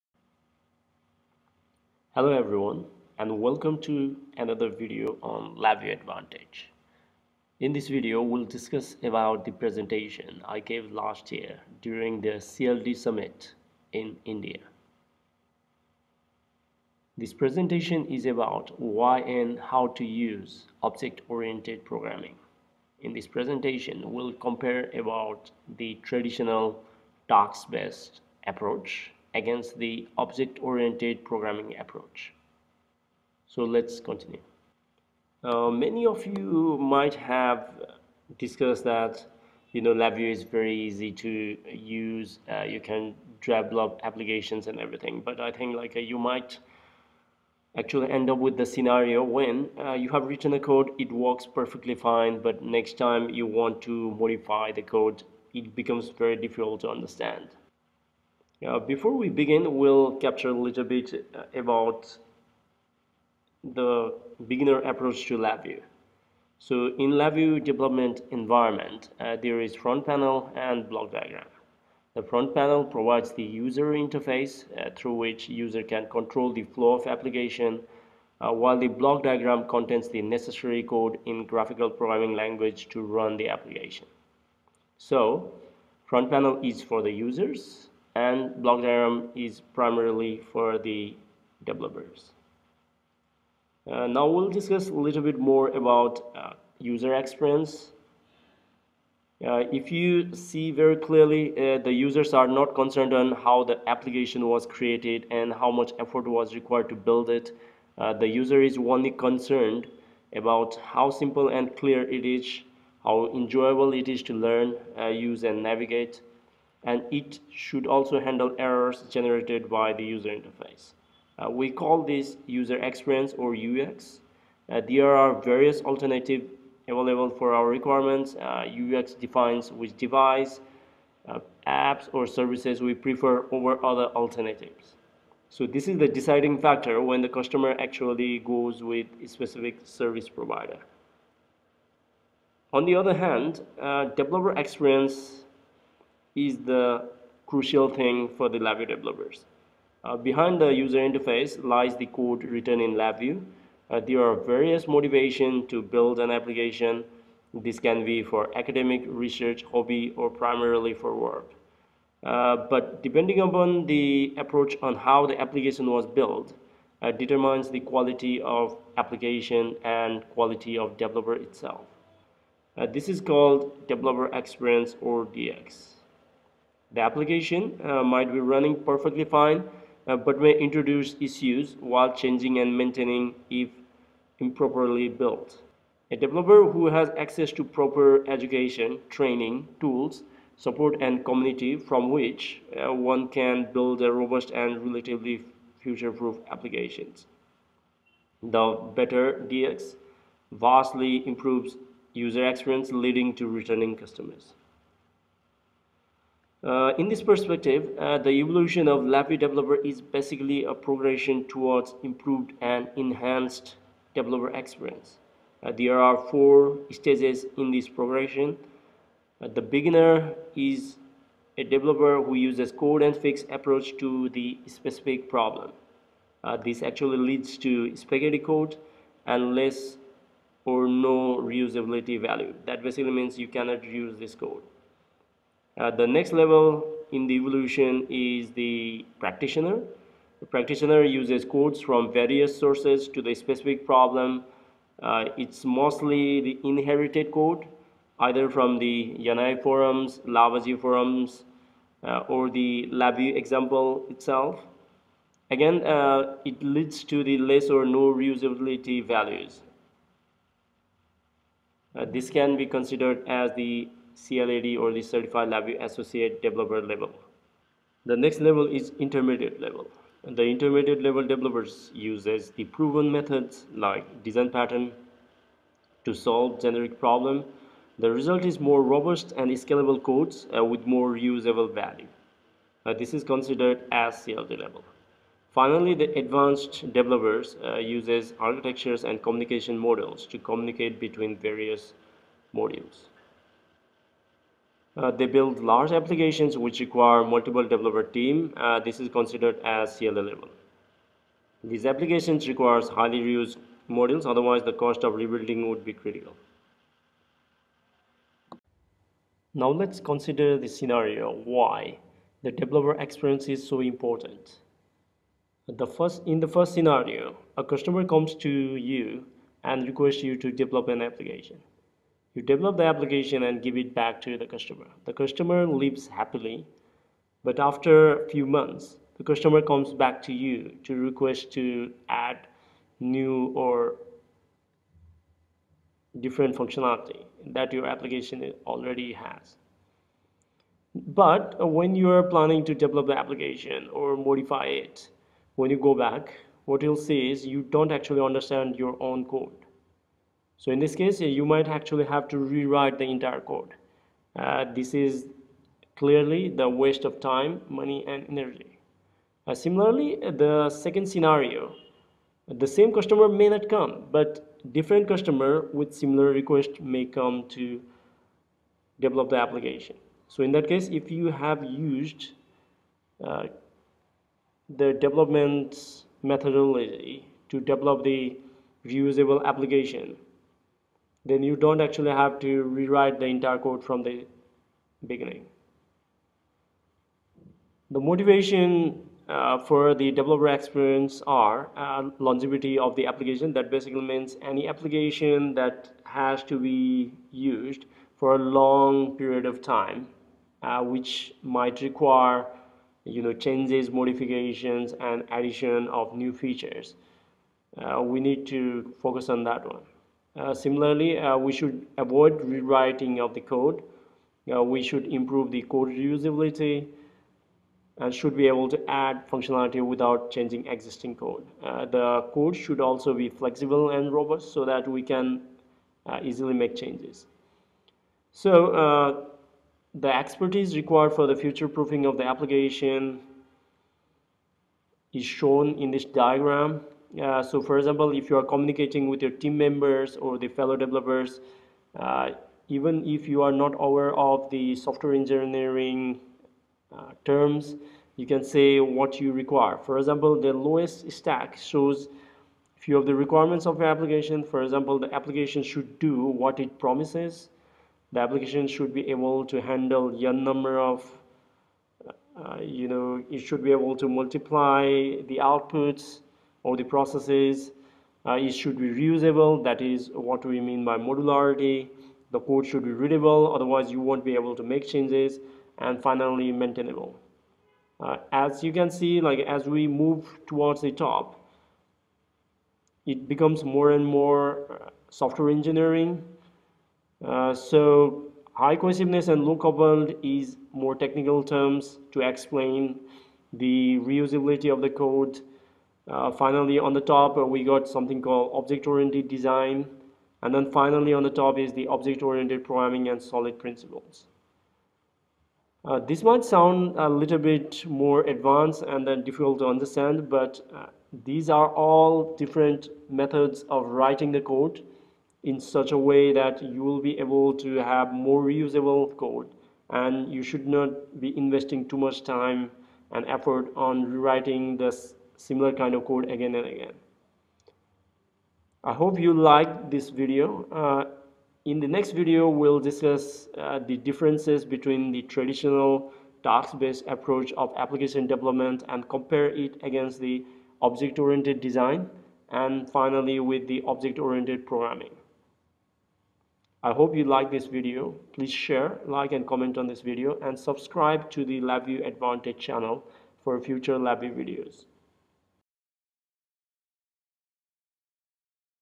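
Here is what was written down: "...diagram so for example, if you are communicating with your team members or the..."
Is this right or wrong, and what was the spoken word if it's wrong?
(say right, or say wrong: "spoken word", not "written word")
right.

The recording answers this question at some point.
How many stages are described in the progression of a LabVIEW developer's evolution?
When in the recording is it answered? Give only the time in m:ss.
3:36.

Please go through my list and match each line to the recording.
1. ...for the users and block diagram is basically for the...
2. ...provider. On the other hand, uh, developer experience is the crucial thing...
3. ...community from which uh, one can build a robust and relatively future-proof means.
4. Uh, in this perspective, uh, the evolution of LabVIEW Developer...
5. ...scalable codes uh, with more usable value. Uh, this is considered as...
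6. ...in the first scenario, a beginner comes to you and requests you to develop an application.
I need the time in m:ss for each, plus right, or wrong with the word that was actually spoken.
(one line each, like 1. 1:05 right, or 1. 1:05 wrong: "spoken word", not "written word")
1. 1:26 wrong: "primarily", not "basically"
2. 2:20 right
3. 3:11 wrong: "applications", not "means"
4. 3:26 right
5. 4:39 right
6. 5:16 wrong: "customer", not "beginner".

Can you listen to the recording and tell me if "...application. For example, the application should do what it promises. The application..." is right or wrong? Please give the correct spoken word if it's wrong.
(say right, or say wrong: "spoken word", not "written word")
right.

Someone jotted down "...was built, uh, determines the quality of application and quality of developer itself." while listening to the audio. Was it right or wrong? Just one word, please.
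right.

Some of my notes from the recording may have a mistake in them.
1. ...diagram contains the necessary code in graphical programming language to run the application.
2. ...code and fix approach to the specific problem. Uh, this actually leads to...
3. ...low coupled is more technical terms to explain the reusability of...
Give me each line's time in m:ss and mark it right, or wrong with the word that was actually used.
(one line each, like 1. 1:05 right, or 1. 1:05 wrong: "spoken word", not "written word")
1. 1:19 right
2. 3:42 right
3. 8:09 right.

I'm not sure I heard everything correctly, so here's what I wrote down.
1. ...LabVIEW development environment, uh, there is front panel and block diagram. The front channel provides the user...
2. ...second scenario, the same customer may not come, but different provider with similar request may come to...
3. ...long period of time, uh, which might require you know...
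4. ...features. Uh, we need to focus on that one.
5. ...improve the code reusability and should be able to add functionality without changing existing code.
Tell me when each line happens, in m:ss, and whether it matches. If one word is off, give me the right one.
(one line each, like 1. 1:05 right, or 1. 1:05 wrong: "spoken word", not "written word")
1. 1:07 wrong: "panel", not "channel"
2. 6:00 wrong: "customer", not "provider"
3. 6:38 right
4. 6:46 right
5. 6:55 right.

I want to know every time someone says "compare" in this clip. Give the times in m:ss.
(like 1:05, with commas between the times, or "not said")
0:24, 8:59.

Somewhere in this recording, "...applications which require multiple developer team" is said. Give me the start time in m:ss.
4:55.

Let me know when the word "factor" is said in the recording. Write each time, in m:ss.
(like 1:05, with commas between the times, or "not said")
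2:16.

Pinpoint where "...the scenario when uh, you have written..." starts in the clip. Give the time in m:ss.
0:48.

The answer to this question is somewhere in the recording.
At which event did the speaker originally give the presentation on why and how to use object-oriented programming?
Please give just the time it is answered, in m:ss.
0:12.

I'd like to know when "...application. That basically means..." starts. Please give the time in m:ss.
6:33.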